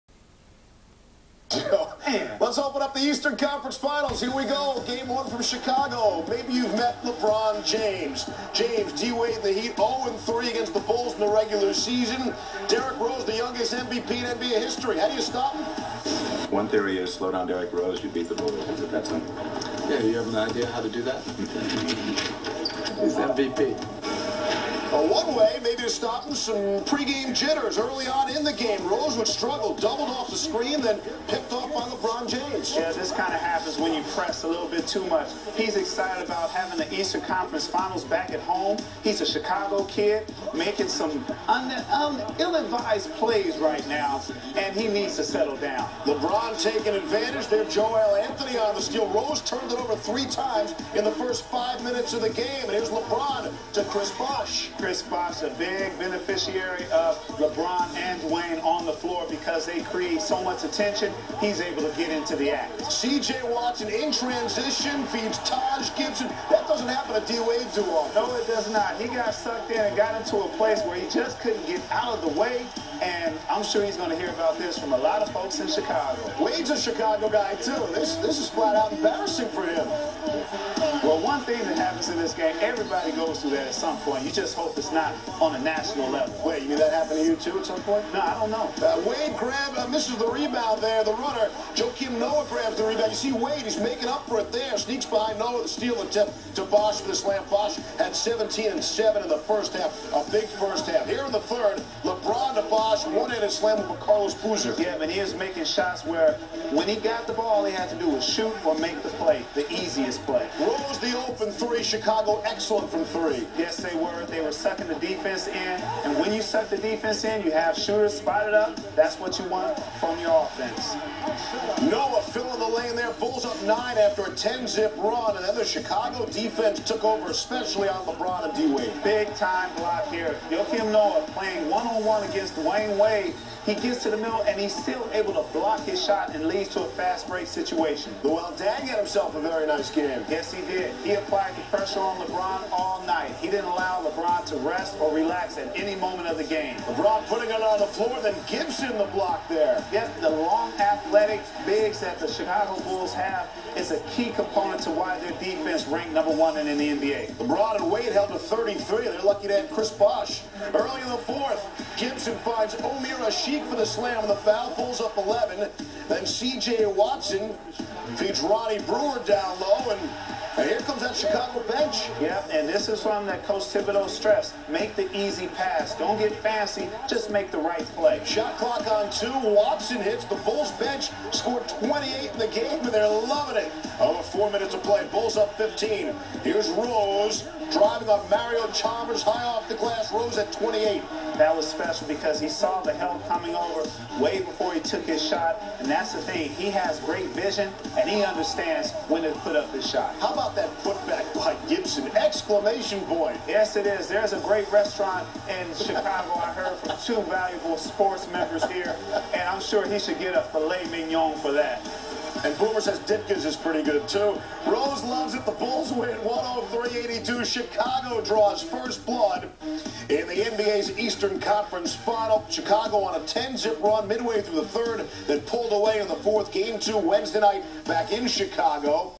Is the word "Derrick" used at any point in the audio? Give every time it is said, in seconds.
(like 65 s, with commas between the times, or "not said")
12 s, 17 s.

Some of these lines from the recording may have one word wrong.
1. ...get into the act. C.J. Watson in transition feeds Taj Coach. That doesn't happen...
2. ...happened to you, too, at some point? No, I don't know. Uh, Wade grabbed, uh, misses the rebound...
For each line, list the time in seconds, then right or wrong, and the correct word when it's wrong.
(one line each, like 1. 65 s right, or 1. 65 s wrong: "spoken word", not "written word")
1. 61 s wrong: "Gibson", not "Coach"
2. 86 s right.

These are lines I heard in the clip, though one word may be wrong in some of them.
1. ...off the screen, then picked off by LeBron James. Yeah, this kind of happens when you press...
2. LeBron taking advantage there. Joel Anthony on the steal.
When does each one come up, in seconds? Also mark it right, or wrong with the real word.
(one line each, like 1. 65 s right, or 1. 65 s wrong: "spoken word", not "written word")
1. 30 s right
2. 46 s right.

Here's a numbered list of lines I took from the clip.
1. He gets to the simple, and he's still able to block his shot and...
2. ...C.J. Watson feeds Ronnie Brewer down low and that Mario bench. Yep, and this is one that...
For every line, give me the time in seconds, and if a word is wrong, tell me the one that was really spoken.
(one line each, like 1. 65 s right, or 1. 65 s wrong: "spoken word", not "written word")
1. 133 s wrong: "middle", not "simple"
2. 166 s wrong: "Chicago", not "Mario".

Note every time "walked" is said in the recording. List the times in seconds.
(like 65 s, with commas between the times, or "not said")
not said.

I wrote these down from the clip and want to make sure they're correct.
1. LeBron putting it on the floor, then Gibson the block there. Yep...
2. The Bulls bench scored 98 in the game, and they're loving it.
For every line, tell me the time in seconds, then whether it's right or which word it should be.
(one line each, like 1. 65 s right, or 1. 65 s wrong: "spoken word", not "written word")
1. 146 s right
2. 180 s wrong: "28", not "98".